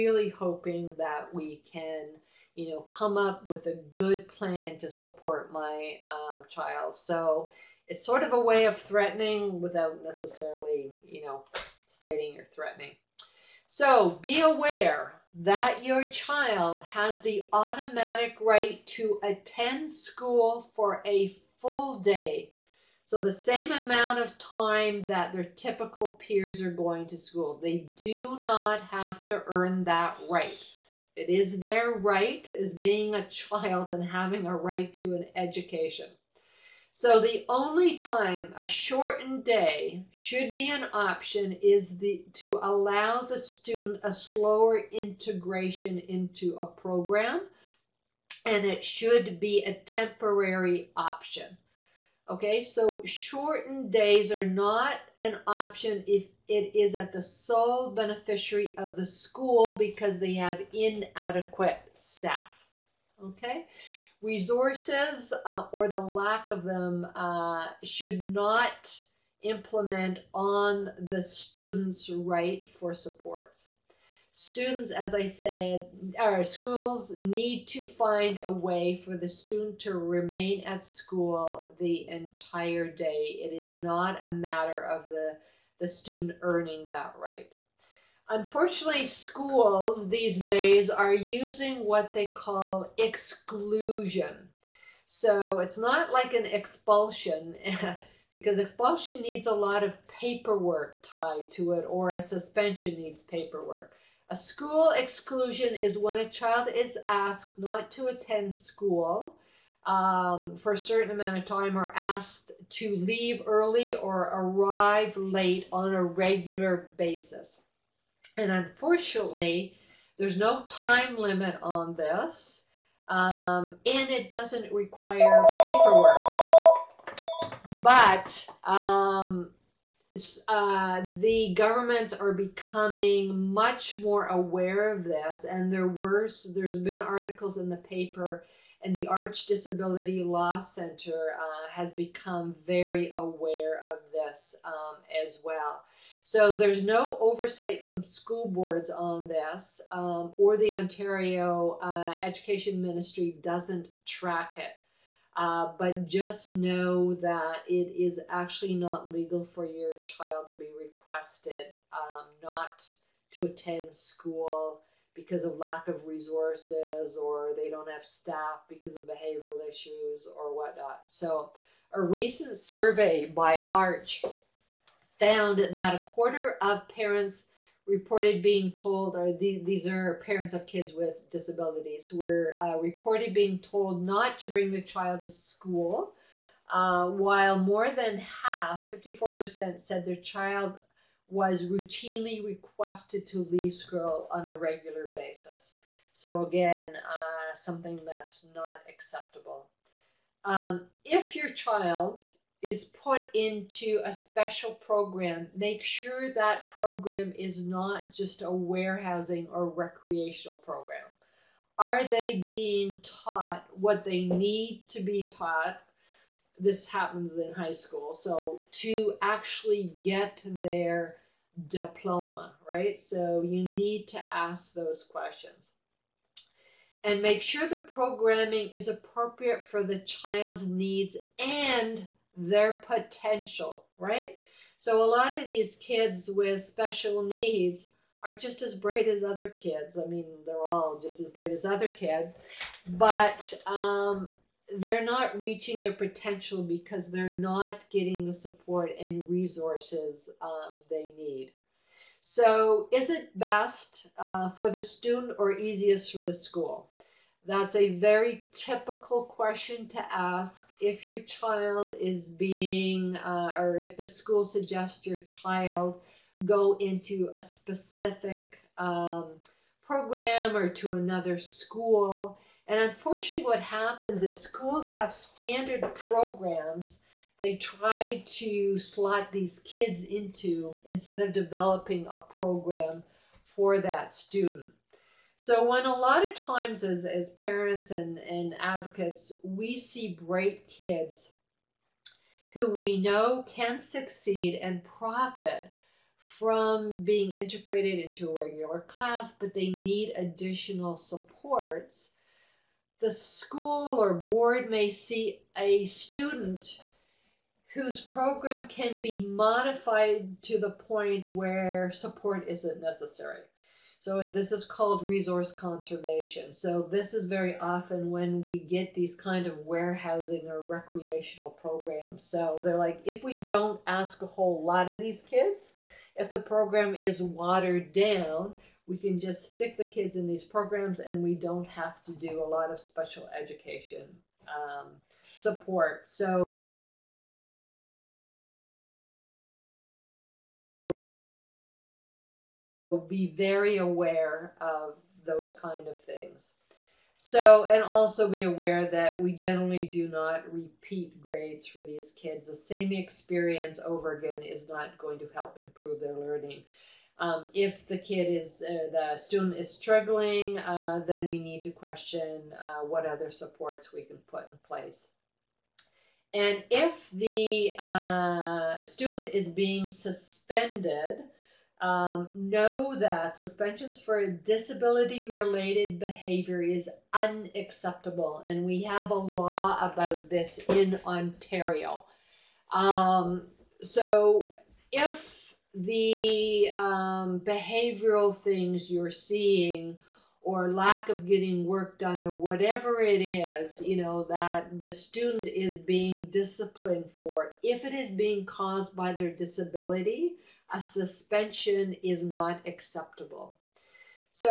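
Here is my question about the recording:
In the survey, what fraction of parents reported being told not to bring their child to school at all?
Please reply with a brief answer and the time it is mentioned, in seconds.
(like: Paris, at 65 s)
a quarter, at 175 s.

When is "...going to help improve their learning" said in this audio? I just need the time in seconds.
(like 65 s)
354 s.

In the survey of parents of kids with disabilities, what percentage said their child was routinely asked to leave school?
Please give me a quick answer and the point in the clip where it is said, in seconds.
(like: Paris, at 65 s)
54%, at 188 s.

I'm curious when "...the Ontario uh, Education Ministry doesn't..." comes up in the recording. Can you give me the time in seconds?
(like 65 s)
150 s.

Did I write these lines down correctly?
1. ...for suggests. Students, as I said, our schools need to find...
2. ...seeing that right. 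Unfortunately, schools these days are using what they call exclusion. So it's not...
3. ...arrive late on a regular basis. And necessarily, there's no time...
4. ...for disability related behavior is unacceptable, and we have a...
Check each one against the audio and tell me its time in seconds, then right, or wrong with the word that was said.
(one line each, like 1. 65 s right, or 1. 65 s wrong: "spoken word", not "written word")
1. 72 s wrong: "supports", not "suggests"
2. 86 s wrong: "earning", not "seeing"
3. 114 s wrong: "unfortunately", not "necessarily"
4. 373 s right.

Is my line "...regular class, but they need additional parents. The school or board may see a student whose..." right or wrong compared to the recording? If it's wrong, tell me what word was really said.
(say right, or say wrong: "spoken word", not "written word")
wrong: "supports", not "parents".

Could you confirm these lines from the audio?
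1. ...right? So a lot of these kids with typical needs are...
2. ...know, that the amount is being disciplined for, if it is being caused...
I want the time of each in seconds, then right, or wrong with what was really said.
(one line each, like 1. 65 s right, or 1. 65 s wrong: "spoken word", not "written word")
1. 233 s wrong: "special", not "typical"
2. 394 s wrong: "student", not "amount".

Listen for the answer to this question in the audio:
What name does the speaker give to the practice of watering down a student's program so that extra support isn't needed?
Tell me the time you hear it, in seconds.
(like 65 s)
315 s.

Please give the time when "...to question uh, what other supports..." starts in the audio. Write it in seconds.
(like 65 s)
361 s.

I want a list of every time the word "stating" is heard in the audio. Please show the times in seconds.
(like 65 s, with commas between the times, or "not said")
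11 s.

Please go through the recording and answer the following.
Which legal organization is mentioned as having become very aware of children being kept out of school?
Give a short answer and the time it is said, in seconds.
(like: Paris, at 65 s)
ARCH Disability Law Center, at 139 s.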